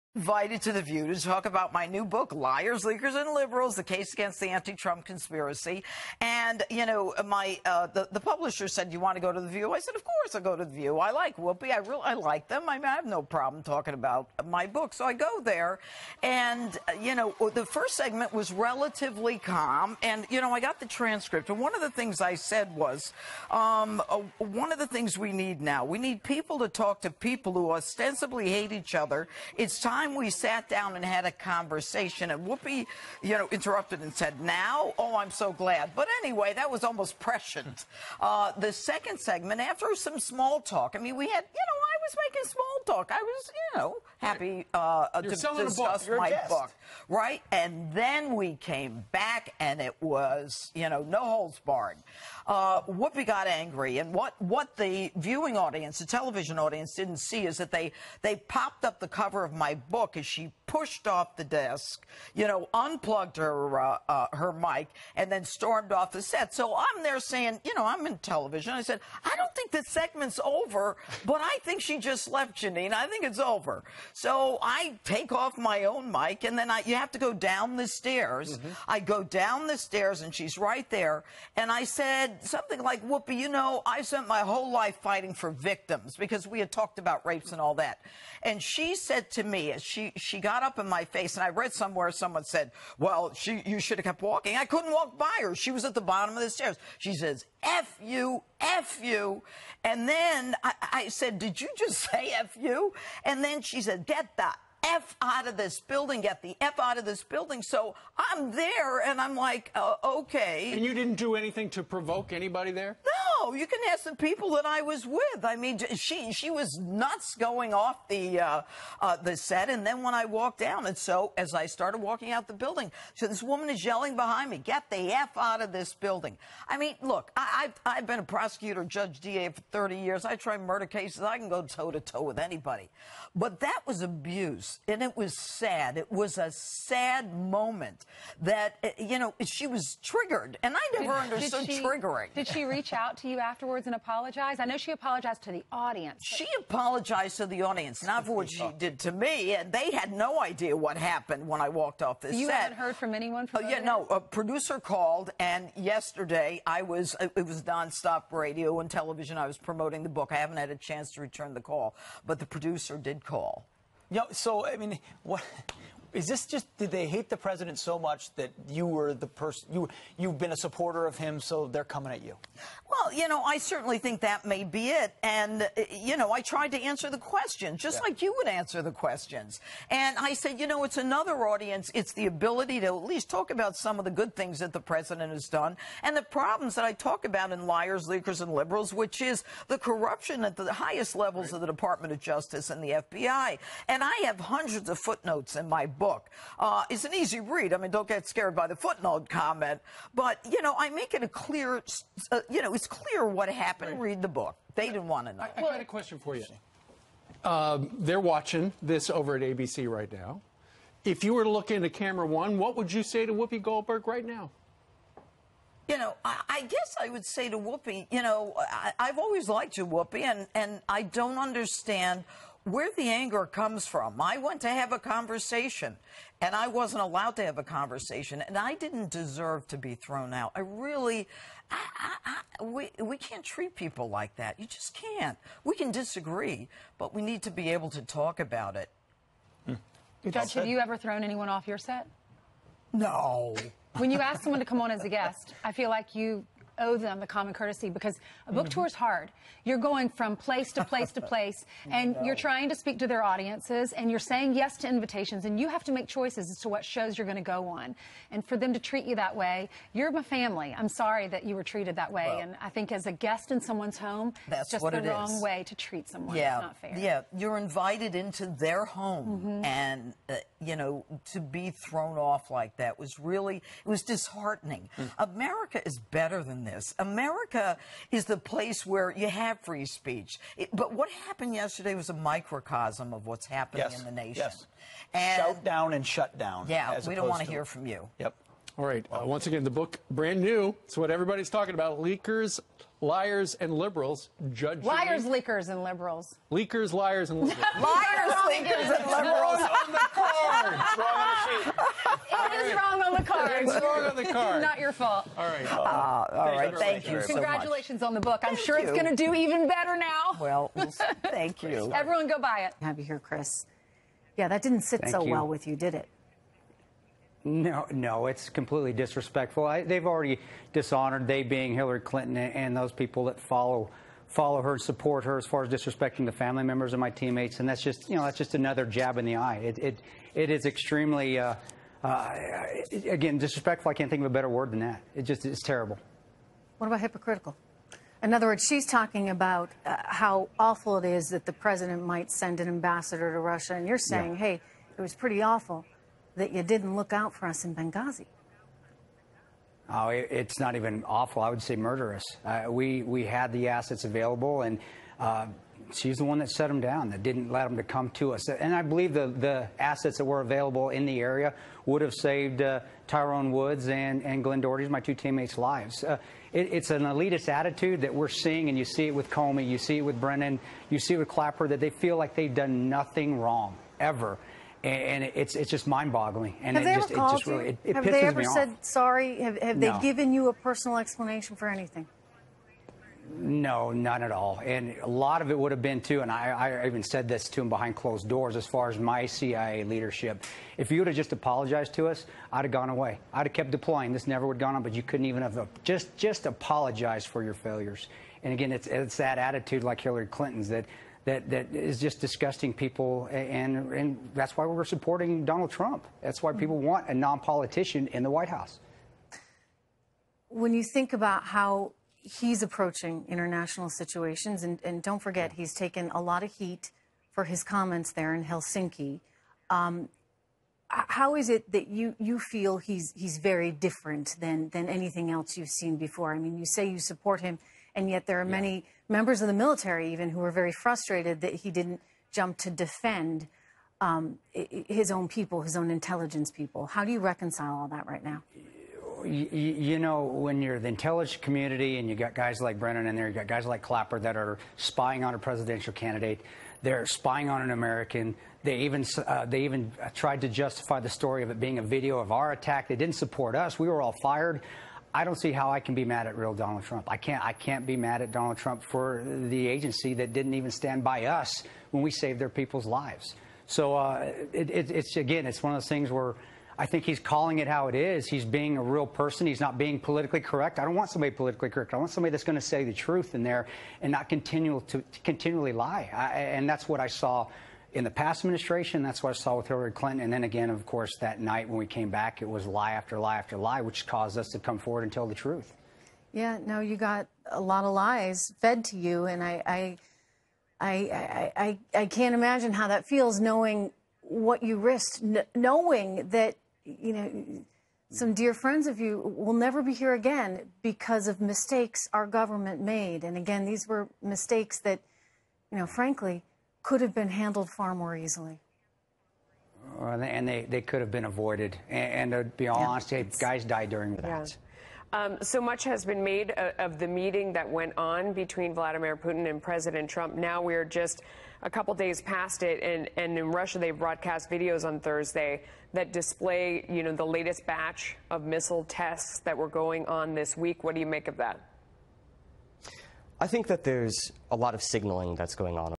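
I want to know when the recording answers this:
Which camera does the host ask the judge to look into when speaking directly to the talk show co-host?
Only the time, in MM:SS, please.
03:31.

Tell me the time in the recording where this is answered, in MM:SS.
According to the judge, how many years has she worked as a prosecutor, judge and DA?
02:09.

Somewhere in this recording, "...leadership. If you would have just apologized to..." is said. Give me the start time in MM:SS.
06:29.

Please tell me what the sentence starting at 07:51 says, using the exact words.
I want somebody that's going to say the truth in there and not continue to, to continually lie.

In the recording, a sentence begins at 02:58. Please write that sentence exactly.
like you would answer the questions, and I said, you know, it's another audience.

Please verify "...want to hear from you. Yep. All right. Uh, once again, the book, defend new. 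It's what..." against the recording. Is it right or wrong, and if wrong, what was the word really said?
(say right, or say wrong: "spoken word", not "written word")
wrong: "brand", not "defend".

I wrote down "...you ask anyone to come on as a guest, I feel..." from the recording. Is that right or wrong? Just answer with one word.
wrong.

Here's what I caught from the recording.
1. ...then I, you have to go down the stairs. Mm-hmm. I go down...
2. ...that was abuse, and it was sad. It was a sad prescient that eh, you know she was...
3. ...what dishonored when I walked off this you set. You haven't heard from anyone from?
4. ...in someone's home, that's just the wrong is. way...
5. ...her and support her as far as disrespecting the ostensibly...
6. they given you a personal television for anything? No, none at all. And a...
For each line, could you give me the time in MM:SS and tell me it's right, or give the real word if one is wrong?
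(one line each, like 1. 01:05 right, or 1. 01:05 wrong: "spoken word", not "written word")
1. 01:16 right
2. 02:13 wrong: "moment", not "prescient"
3. 02:30 wrong: "happened", not "dishonored"
4. 04:23 right
5. 05:24 wrong: "family", not "ostensibly"
6. 06:19 wrong: "explanation", not "television".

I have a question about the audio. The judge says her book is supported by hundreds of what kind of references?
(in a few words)
footnotes.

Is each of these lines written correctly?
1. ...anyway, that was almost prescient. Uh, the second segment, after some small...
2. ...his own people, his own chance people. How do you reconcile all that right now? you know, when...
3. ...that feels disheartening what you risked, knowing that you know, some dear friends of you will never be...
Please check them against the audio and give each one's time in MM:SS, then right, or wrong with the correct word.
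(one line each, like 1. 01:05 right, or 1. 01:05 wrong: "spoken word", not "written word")
1. 00:36 right
2. 07:14 wrong: "intelligence", not "chance"
3. 08:12 wrong: "knowing", not "disheartening".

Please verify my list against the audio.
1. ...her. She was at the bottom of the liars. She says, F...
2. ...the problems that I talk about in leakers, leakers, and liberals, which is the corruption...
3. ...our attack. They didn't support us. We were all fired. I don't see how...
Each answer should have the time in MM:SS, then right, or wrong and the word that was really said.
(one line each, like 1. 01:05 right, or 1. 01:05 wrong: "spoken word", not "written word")
1. 01:35 wrong: "stairs", not "liars"
2. 03:06 wrong: "liars", not "leakers"
3. 07:32 right.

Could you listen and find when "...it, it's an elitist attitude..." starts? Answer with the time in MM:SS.
06:06.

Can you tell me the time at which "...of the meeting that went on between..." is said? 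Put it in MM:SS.
08:36.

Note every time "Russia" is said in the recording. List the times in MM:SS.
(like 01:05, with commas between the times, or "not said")
05:43, 08:43.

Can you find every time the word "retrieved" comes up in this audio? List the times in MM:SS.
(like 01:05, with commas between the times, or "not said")
not said.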